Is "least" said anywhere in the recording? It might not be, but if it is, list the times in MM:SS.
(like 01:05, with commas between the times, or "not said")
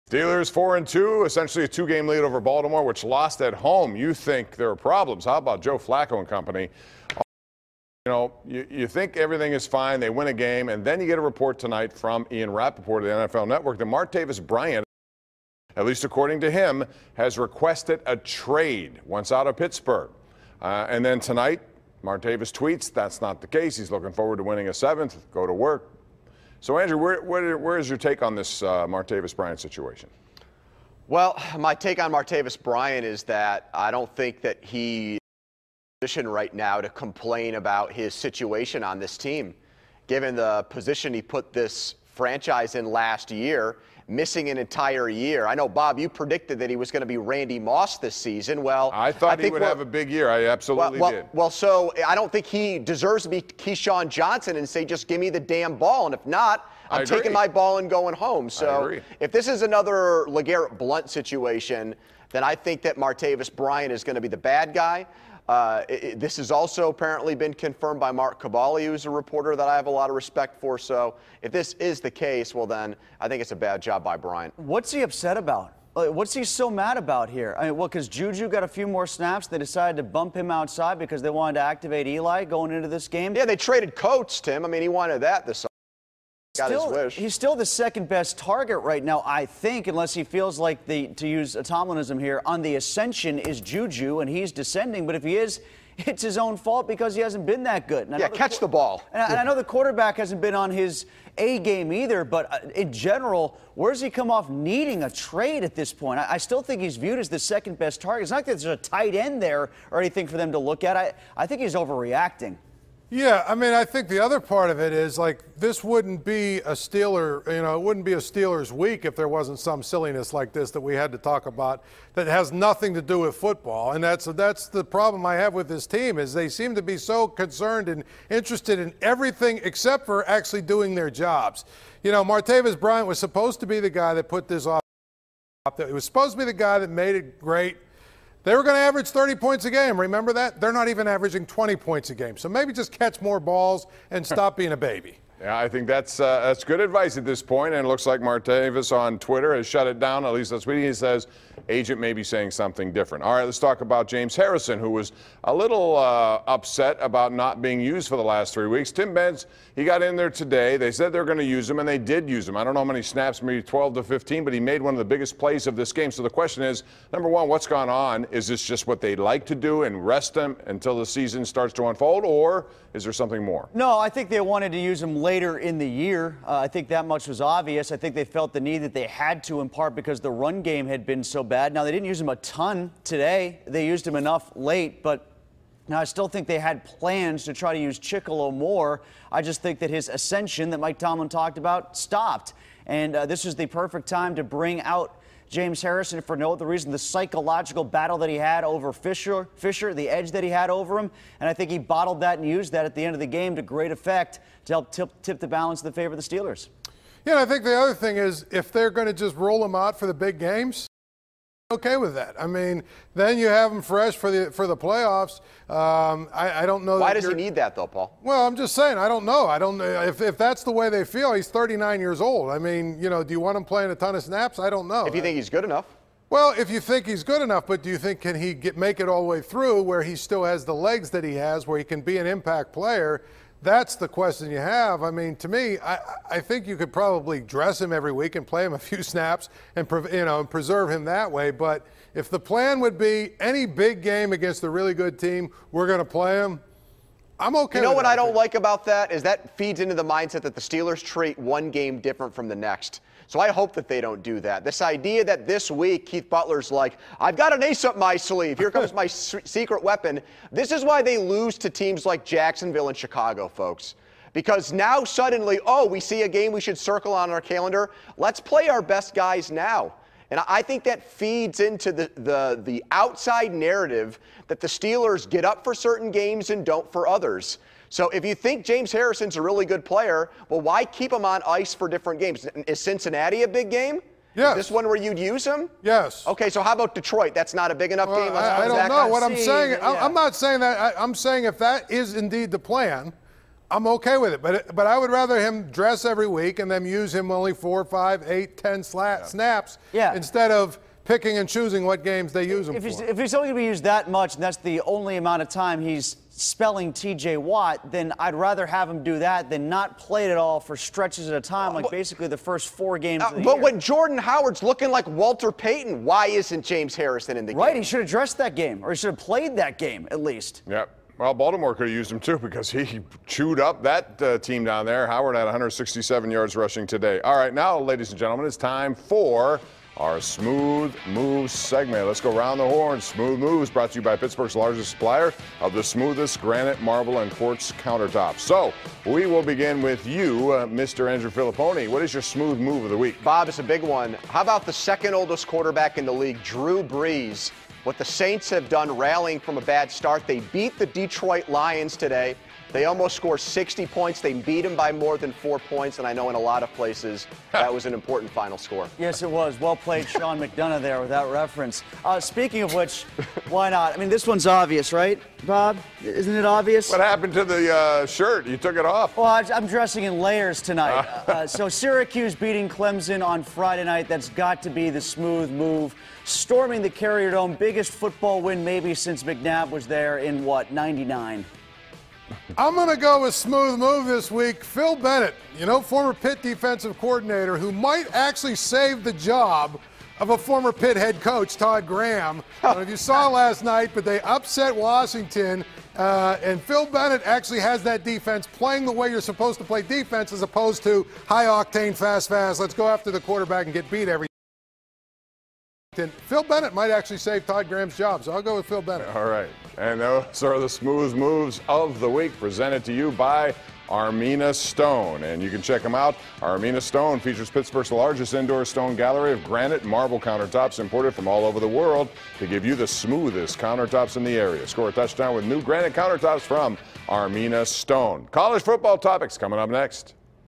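00:15, 02:30, 05:20.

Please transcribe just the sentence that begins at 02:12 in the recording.
You know, Martavis Bryant was supposed to be the guy that put this off.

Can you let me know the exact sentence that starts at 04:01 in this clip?
But if the plan would be any big game against a really good team, we're going to play him.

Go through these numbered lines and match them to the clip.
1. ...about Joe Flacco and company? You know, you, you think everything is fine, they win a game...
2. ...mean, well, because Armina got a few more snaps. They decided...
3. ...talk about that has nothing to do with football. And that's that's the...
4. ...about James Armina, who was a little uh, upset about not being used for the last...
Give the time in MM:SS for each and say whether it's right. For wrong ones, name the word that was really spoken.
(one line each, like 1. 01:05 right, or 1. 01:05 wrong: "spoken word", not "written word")
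1. 00:05 right
2. 01:17 wrong: "Juju", not "Armina"
3. 02:01 right
4. 02:33 wrong: "Harrison", not "Armina".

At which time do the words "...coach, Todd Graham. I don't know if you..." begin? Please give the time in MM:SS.
06:31.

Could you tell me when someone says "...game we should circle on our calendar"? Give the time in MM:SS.
04:26.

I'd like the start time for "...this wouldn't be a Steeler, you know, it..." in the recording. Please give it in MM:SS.
01:55.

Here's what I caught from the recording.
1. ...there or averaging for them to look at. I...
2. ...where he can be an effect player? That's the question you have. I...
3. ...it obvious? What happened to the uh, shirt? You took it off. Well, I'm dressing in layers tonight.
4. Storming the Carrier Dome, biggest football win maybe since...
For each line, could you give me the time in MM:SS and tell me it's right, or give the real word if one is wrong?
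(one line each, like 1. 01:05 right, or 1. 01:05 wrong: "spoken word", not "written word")
1. 01:49 wrong: "anything", not "averaging"
2. 03:51 wrong: "impact", not "effect"
3. 06:06 right
4. 06:16 right.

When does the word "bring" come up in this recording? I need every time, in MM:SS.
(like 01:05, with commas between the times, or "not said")
03:14.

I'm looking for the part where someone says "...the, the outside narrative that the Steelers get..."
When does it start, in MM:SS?
04:32.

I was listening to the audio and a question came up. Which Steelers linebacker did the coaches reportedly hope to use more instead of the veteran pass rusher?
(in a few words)
Chickillo.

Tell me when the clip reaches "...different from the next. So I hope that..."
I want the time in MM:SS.
04:11.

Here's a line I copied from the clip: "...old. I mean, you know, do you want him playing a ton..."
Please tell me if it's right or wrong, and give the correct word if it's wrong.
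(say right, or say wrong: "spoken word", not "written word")
right.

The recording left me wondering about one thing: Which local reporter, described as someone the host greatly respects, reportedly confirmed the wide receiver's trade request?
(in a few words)
Mark Kaboly.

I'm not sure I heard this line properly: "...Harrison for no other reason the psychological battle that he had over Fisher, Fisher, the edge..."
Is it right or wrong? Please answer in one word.
right.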